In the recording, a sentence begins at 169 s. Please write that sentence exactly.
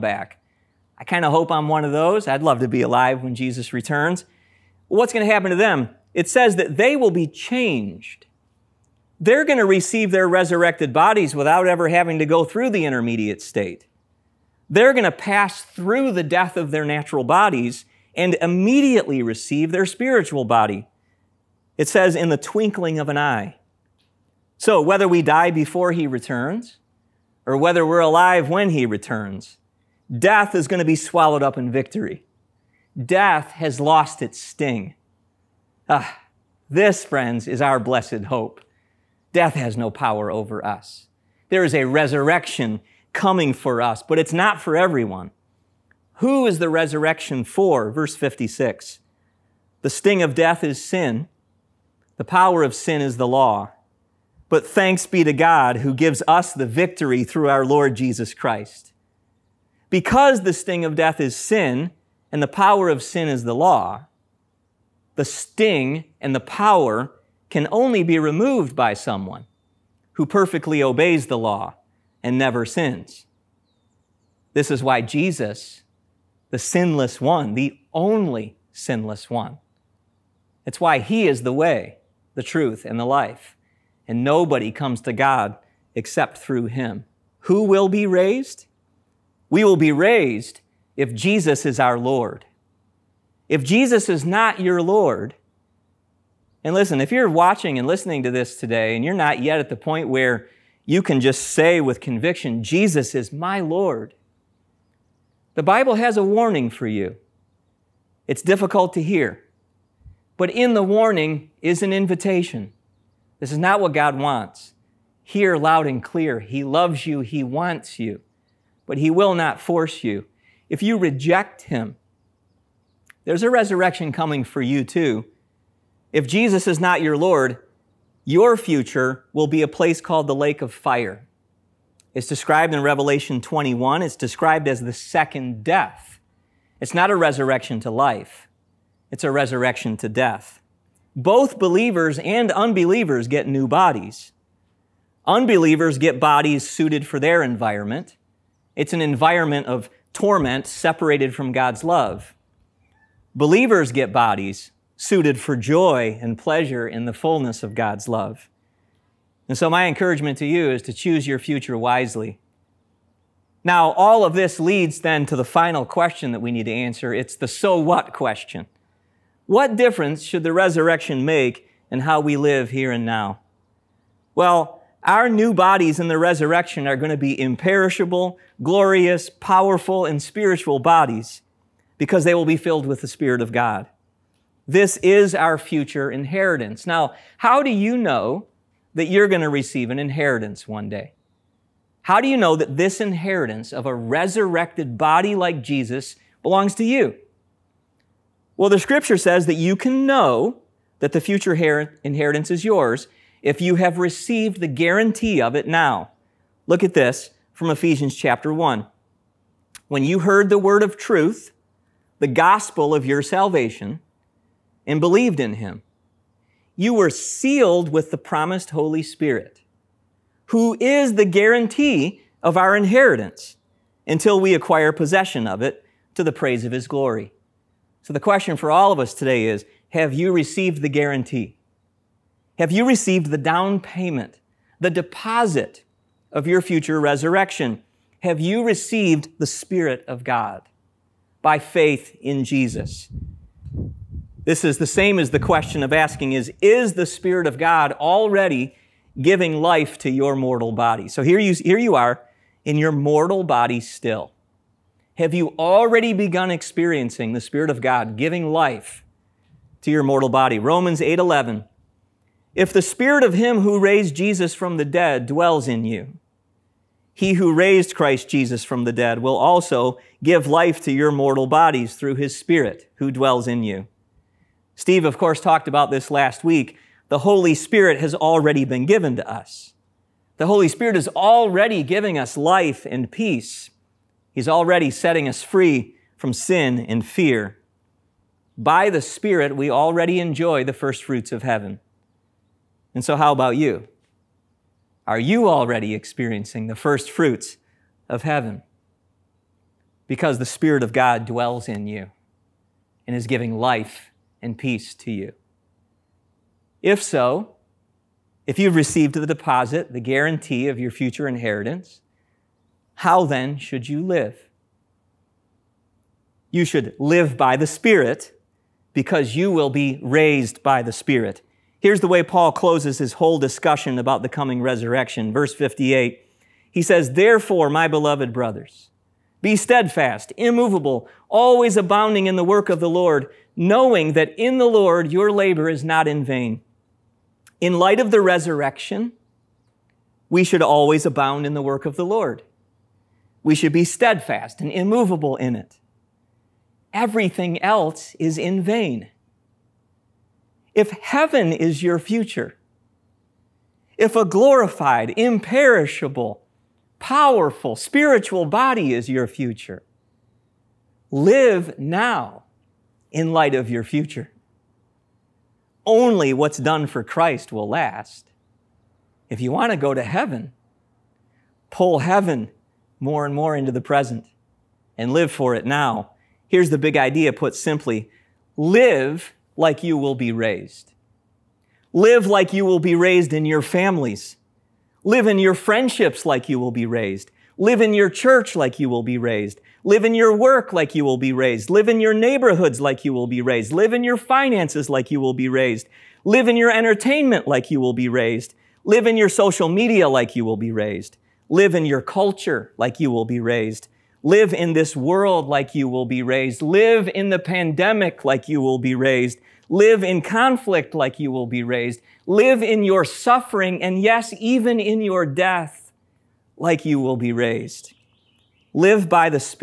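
What difference should the resurrection make in how we live here and now?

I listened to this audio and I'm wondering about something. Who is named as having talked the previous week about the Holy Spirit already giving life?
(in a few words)
Steve.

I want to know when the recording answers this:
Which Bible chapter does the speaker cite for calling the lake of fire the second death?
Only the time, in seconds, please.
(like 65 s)
132 s.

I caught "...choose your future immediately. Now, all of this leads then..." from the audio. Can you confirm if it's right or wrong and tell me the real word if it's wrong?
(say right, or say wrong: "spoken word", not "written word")
wrong: "wisely", not "immediately".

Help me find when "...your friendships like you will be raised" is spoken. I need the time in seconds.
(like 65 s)
385 s.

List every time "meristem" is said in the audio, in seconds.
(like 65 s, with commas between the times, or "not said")
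not said.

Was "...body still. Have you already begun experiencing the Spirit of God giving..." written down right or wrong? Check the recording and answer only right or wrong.
right.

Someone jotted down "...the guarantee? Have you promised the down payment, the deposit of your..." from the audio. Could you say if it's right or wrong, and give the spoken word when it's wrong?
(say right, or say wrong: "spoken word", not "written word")
wrong: "received", not "promised".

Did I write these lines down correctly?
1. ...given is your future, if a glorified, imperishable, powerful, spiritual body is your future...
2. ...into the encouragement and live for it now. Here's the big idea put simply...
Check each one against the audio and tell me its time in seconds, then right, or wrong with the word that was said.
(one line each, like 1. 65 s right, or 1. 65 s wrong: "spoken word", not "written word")
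1. 350 s wrong: "heaven", not "given"
2. 373 s wrong: "present", not "encouragement".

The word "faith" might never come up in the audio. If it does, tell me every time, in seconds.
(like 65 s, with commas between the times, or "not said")
241 s.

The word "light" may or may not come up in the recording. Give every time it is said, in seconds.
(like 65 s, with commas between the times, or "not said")
337 s, 363 s.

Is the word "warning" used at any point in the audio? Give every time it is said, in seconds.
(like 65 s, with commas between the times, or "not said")
106 s, 110 s.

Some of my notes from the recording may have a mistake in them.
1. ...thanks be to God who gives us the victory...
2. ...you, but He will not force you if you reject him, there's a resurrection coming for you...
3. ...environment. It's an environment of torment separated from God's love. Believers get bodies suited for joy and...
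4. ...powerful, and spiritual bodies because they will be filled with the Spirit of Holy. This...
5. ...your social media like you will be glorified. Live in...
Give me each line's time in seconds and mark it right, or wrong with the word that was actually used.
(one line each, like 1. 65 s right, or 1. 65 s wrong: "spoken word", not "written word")
1. 54 s right
2. 117 s right
3. 147 s right
4. 179 s wrong: "God", not "Holy"
5. 399 s wrong: "raised", not "glorified".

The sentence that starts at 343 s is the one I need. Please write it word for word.
We should be steadfast and immovable in it.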